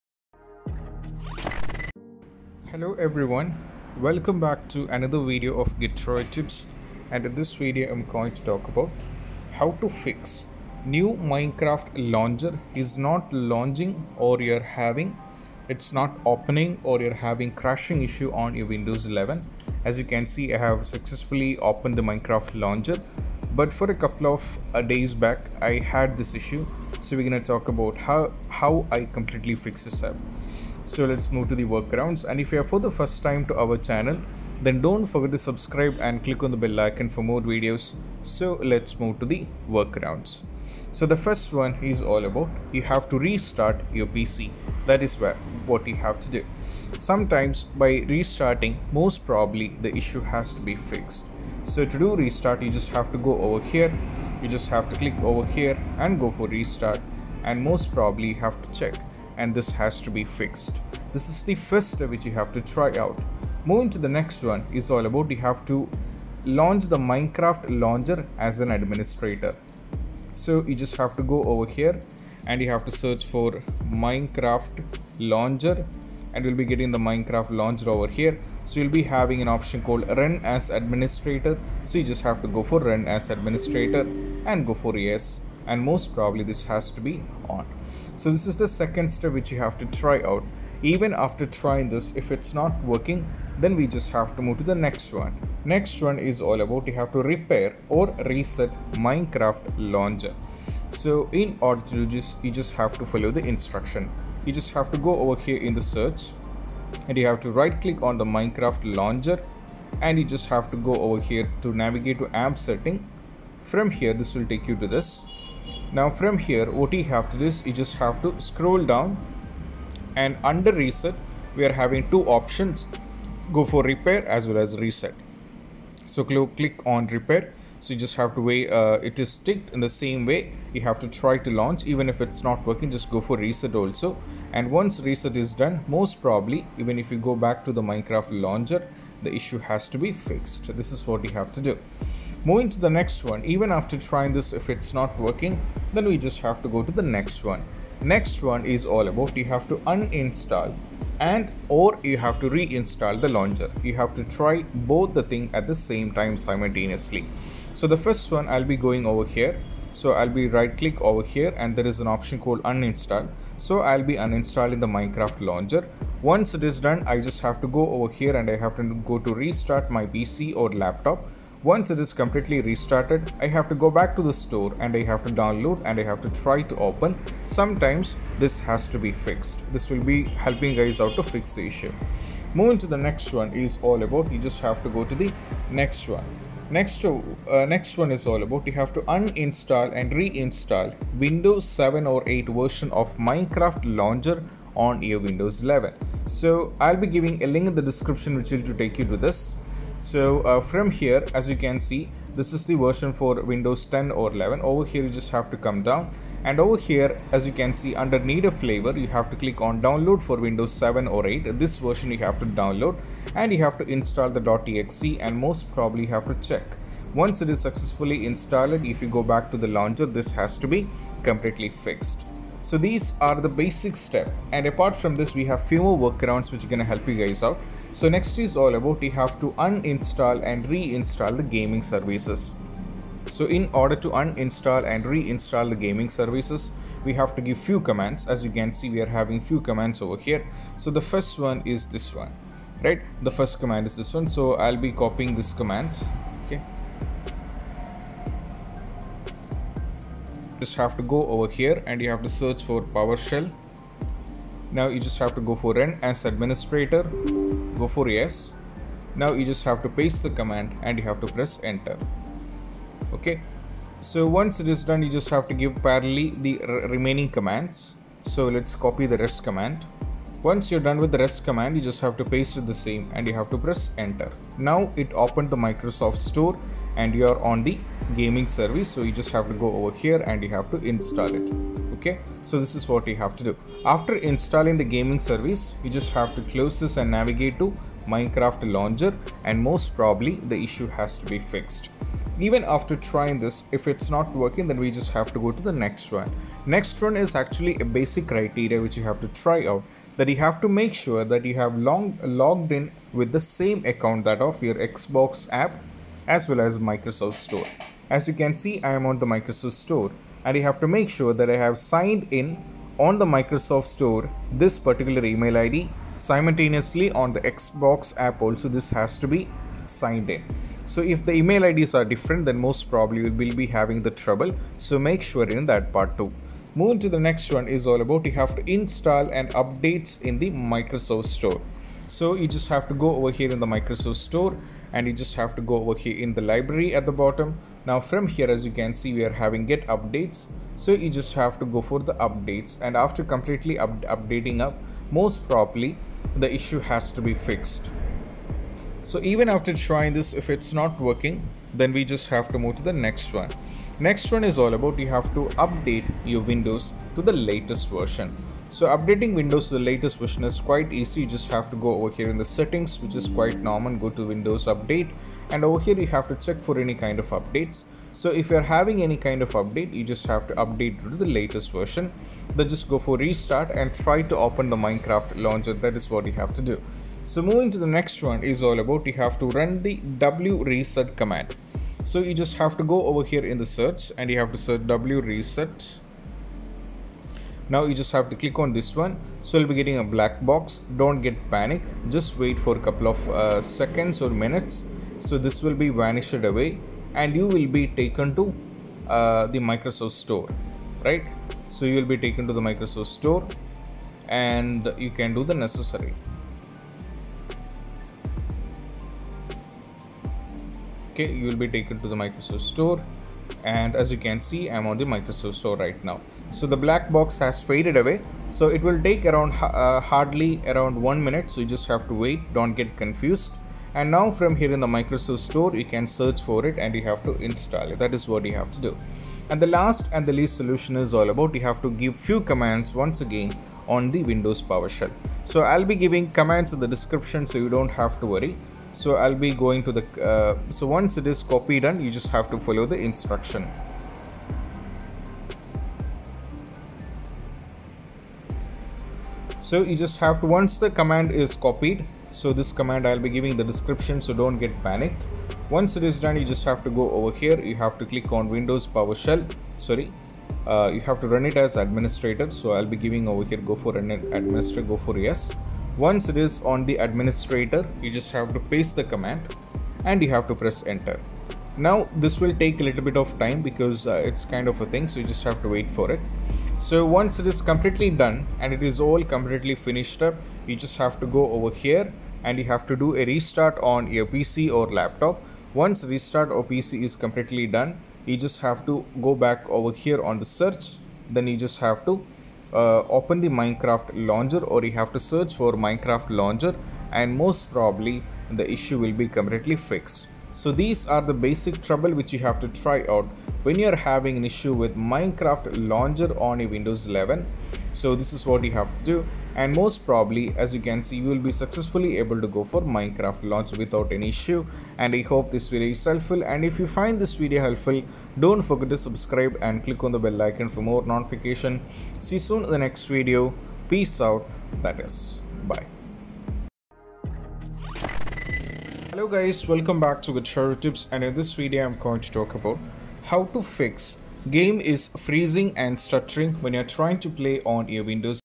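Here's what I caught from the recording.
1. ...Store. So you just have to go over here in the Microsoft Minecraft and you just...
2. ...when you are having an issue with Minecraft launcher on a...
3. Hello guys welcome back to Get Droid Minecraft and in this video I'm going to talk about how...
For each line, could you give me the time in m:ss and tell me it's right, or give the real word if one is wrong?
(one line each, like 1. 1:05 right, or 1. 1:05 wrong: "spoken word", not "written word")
1. 5:31 wrong: "Store", not "Minecraft"
2. 8:23 right
3. 8:49 wrong: "Tips", not "Minecraft".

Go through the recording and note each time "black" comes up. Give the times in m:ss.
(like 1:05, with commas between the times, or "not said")
6:30, 6:56.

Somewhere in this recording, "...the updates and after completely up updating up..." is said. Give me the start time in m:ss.
5:41.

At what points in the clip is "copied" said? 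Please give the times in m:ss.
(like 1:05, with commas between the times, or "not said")
7:21, 7:31.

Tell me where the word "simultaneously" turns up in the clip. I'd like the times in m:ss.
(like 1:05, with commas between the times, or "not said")
2:36, 5:16.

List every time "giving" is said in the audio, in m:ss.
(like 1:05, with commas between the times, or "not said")
3:17, 7:15, 7:33, 7:42.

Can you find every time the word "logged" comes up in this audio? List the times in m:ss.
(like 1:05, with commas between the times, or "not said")
5:02.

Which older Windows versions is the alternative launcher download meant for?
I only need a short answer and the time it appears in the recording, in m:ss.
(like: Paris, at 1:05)
Windows 7 or 8, at 3:29.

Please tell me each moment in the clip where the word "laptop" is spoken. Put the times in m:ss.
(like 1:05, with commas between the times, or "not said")
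2:50, 8:04.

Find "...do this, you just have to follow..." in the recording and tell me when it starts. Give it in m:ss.
1:41.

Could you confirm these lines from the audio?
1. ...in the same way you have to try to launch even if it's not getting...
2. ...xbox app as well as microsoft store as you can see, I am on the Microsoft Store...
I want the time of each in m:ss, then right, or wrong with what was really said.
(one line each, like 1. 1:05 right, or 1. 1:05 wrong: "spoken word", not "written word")
1. 2:09 wrong: "working", not "getting"
2. 5:04 right.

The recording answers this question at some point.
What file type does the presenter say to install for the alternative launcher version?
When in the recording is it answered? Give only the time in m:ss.
3:34.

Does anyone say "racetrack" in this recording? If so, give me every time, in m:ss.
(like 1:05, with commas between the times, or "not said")
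not said.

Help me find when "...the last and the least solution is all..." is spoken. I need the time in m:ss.
7:09.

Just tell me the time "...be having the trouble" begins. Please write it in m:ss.
5:23.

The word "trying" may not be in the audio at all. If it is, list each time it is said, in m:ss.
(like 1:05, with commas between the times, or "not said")
1:31, 2:23, 4:52, 5:49, 8:56.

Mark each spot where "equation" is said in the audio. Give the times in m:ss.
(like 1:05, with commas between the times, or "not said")
not said.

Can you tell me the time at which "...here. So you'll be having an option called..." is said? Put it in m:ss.
1:18.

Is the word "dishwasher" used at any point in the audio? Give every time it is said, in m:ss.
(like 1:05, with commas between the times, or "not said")
not said.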